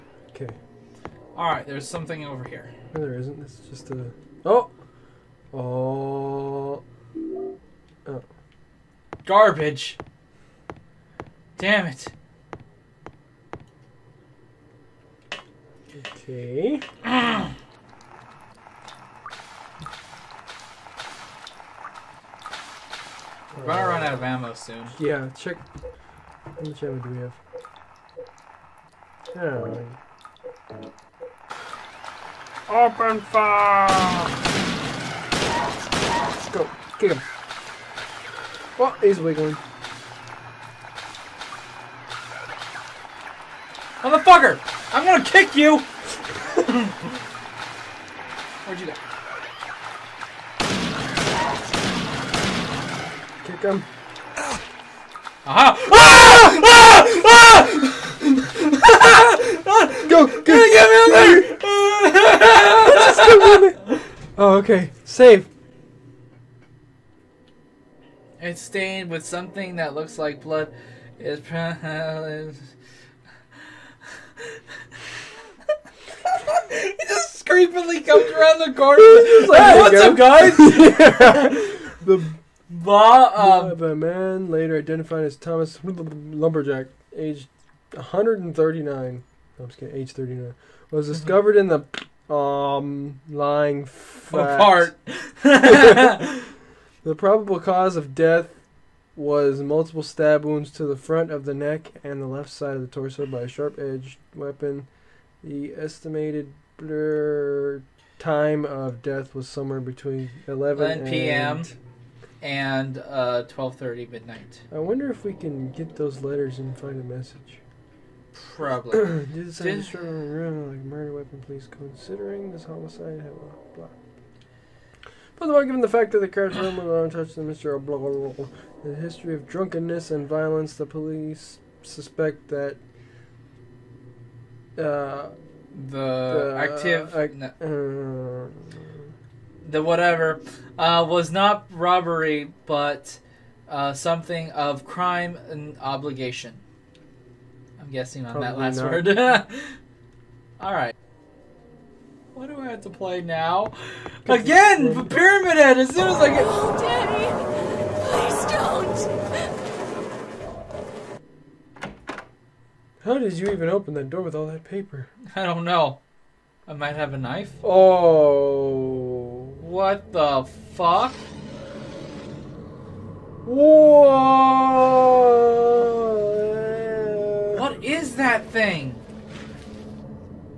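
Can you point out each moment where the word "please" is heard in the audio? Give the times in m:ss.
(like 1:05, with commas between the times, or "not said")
2:01, 2:38.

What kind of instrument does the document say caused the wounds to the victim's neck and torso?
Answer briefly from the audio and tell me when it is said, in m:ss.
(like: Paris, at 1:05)
A sharp-edged weapon, at 1:43.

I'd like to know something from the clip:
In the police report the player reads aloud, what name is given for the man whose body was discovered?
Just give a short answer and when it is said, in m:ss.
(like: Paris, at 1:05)
Thomas Lumberjack, at 1:25.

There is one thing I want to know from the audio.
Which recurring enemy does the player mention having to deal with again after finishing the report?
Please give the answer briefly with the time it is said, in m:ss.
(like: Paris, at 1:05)
Pyramid Head, at 2:35.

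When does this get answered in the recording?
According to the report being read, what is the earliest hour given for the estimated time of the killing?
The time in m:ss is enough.
1:50.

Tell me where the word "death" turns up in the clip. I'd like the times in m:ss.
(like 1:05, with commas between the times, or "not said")
1:38, 1:49.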